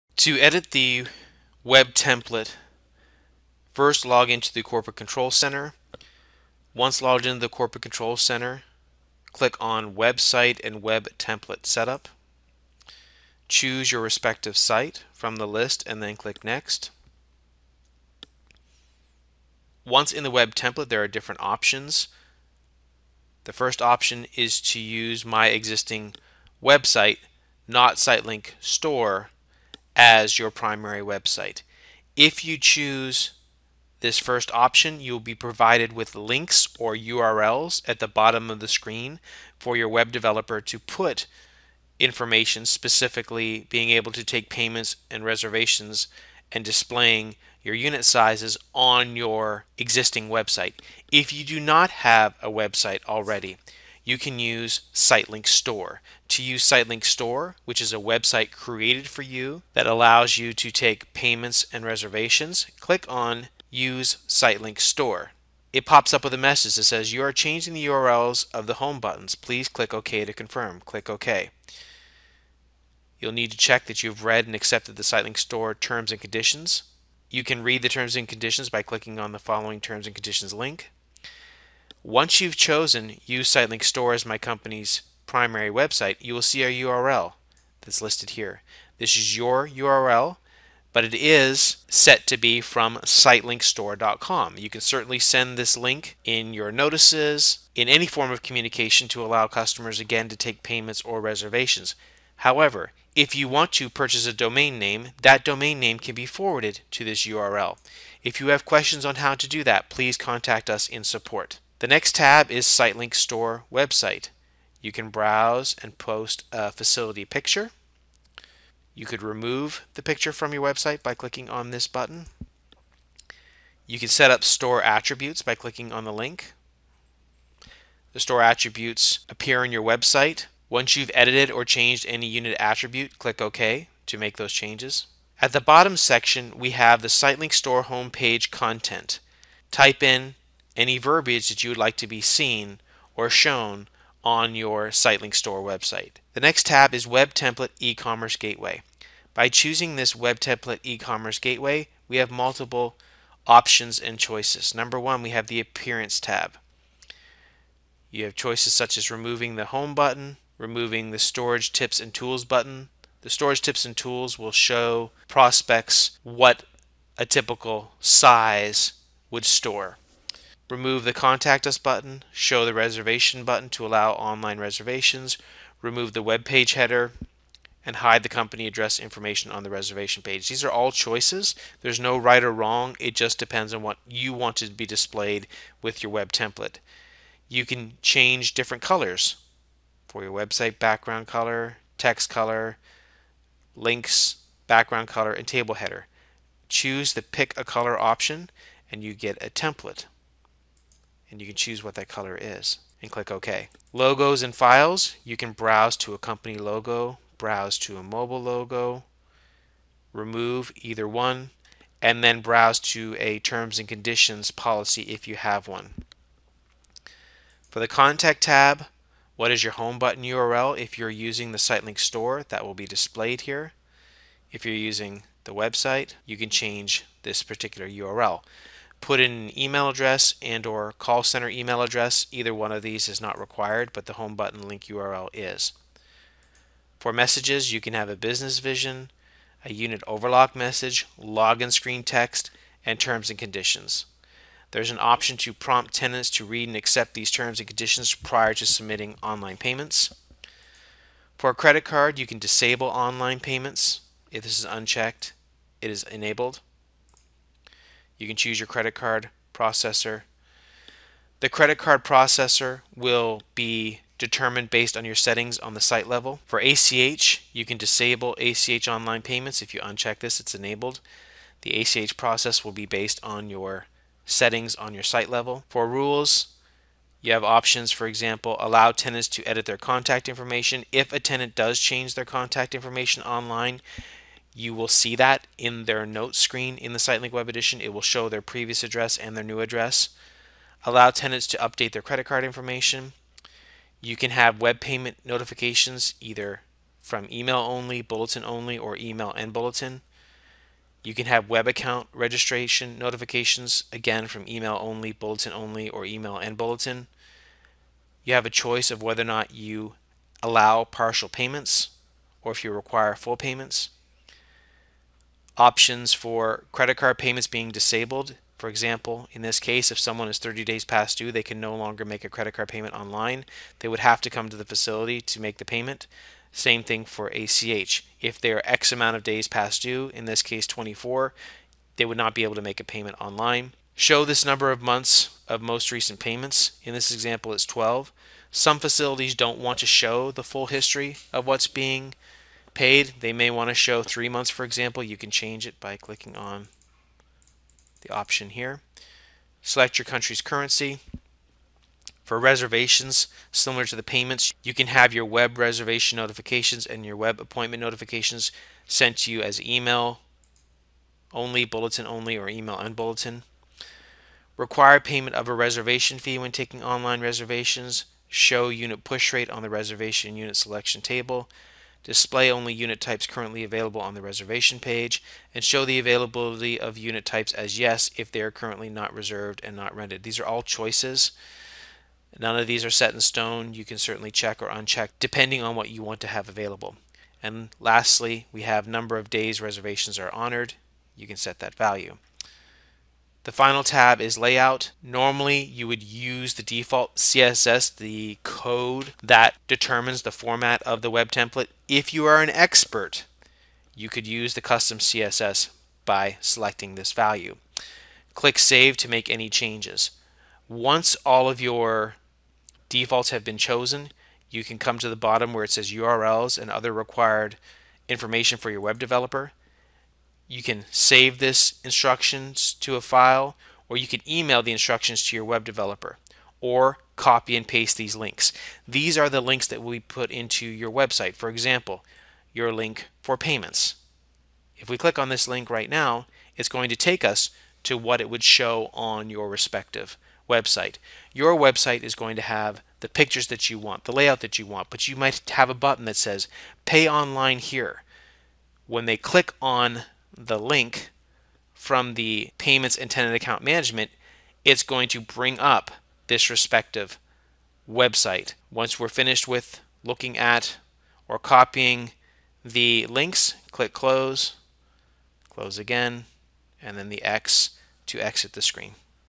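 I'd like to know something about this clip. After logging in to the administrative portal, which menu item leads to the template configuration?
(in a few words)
Website and Web Template Setup.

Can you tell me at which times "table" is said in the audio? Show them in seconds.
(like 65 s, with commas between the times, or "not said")
195 s, 371 s.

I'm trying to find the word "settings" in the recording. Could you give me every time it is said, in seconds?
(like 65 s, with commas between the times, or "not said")
265 s, 274 s.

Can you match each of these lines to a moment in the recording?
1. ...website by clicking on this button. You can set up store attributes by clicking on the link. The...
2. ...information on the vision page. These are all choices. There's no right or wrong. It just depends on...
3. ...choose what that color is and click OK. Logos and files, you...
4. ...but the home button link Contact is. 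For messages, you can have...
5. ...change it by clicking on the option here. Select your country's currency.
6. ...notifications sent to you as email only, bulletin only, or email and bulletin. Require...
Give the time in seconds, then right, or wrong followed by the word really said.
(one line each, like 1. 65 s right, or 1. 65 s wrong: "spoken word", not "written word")
1. 120 s right
2. 178 s wrong: "reservation", not "vision"
3. 201 s right
4. 233 s wrong: "URL", not "Contact"
5. 345 s right
6. 357 s right.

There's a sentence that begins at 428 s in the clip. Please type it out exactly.
These are the links that will be put into your website.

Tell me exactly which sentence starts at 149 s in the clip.
By choosing this Web Template E-Commerce Gateway, we have multiple options and choices.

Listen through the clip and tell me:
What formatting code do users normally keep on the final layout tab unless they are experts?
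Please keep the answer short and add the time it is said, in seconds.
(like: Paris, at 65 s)
default CSS, at 396 s.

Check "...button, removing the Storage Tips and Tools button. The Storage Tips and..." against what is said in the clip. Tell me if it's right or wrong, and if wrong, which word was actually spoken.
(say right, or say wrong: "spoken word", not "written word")
right.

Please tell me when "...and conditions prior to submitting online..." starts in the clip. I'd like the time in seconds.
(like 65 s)
247 s.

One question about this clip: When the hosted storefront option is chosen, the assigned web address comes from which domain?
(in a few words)
sitelinkstore.com.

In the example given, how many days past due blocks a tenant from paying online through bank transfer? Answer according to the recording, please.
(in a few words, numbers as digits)
24.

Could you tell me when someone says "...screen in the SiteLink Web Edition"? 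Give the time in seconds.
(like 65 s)
286 s.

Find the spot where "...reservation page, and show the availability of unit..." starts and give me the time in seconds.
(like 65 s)
374 s.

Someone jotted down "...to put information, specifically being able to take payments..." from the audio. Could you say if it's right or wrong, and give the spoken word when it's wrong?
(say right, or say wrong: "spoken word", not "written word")
right.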